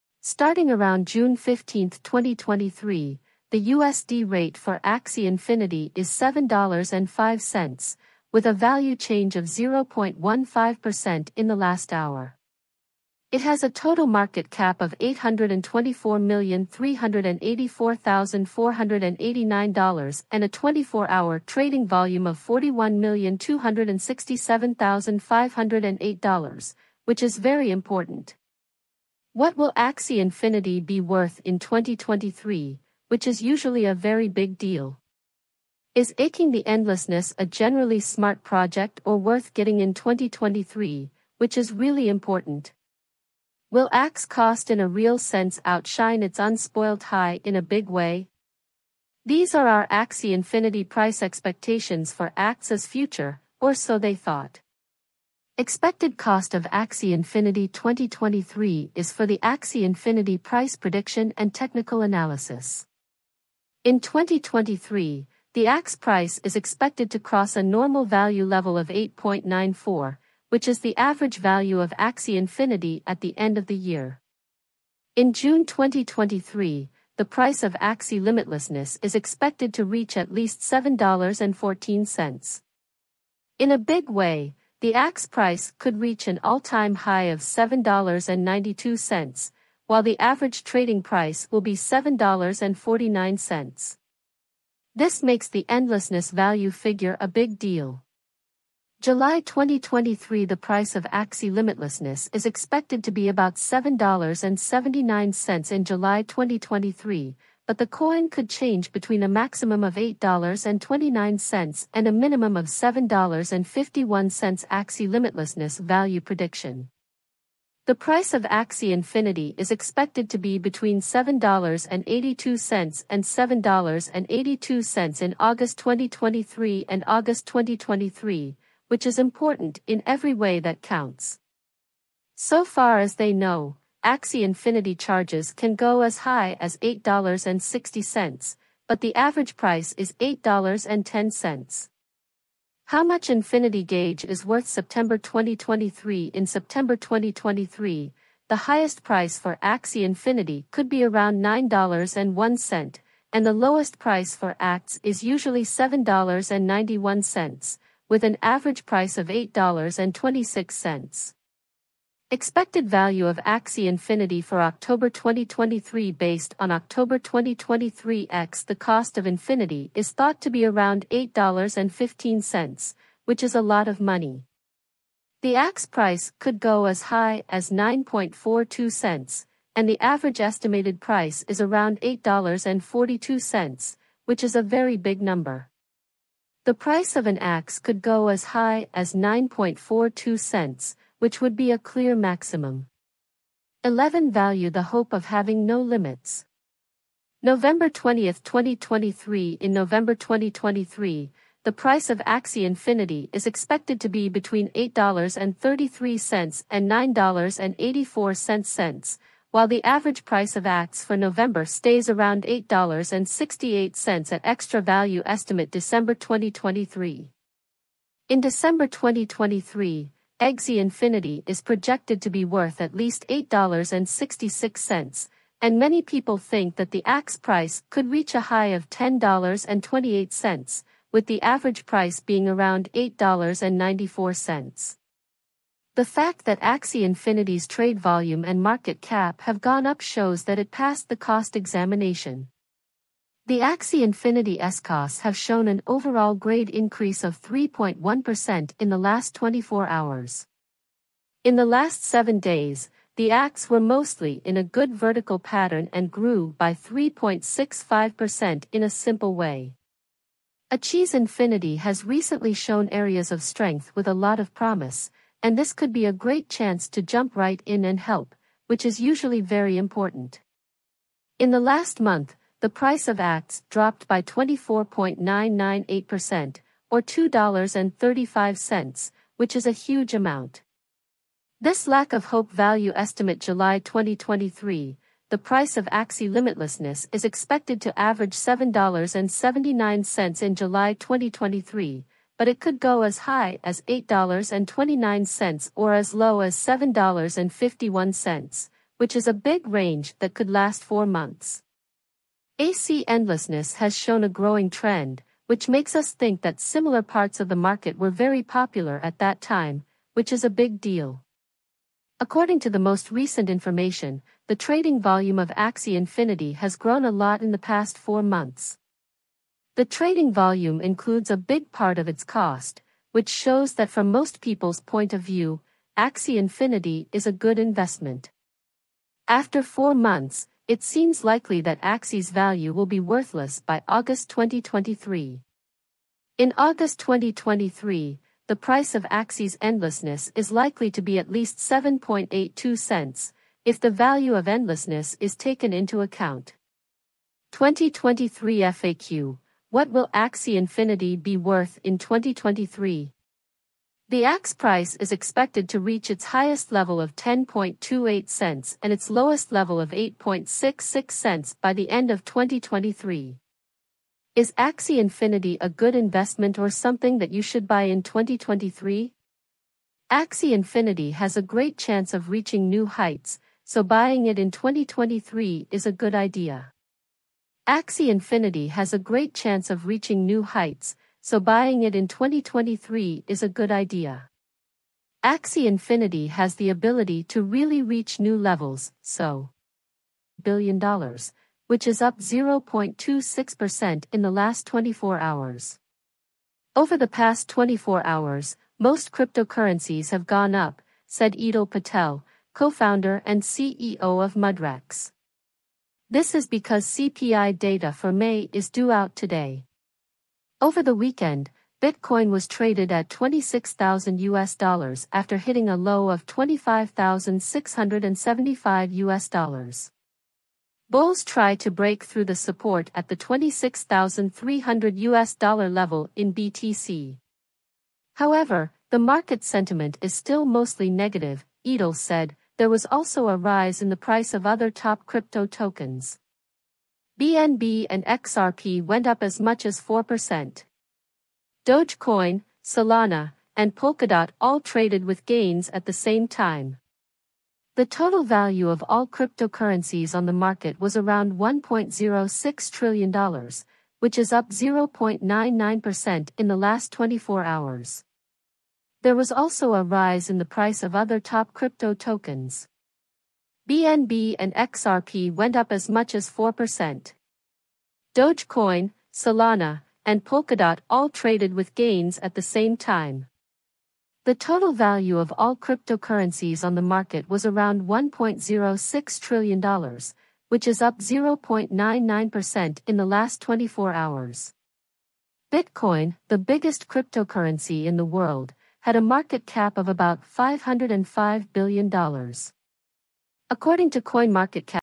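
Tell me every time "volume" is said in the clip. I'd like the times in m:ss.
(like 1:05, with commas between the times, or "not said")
0:21, 3:57, 5:15, 5:20.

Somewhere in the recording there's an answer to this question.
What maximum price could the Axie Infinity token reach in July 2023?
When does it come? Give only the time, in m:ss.
1:49.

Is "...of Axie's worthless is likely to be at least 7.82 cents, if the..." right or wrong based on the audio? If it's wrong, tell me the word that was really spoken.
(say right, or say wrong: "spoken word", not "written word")
wrong: "endlessness", not "worthless".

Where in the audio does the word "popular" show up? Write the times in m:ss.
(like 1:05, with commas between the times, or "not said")
5:08.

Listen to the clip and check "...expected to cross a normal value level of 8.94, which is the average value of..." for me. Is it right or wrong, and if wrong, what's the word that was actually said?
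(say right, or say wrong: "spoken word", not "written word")
right.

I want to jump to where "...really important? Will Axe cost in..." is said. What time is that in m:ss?
0:41.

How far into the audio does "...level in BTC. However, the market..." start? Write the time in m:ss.
7:05.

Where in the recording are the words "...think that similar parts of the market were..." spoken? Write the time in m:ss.
5:06.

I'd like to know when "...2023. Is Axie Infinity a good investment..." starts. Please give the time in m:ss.
6:02.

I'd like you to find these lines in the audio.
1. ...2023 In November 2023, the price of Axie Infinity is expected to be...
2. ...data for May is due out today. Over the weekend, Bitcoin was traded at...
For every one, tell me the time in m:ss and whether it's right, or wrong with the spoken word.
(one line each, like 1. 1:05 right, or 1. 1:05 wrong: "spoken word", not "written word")
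1. 3:18 right
2. 6:47 right.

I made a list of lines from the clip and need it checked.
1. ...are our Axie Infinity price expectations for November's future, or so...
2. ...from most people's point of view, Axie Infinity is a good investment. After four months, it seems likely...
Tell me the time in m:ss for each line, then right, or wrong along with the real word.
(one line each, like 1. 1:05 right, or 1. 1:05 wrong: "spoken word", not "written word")
1. 0:49 wrong: "Axe", not "November"
2. 5:23 right.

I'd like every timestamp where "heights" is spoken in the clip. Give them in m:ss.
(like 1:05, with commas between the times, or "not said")
6:12, 6:20.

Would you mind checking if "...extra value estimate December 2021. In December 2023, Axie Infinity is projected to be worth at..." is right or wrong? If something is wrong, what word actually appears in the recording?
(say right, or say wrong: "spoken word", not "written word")
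wrong: "2023", not "2021".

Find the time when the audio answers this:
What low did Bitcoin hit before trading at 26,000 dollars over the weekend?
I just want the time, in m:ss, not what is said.
6:56.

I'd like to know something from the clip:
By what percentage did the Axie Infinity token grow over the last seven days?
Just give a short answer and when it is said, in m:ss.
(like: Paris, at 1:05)
3.65%, at 4:16.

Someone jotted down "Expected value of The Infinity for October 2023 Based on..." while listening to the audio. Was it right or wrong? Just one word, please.
wrong.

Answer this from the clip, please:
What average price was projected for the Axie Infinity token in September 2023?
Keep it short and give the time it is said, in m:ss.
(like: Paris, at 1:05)
$8.26, at 2:39.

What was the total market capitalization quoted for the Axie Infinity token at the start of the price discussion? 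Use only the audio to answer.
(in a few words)
$824,384,489.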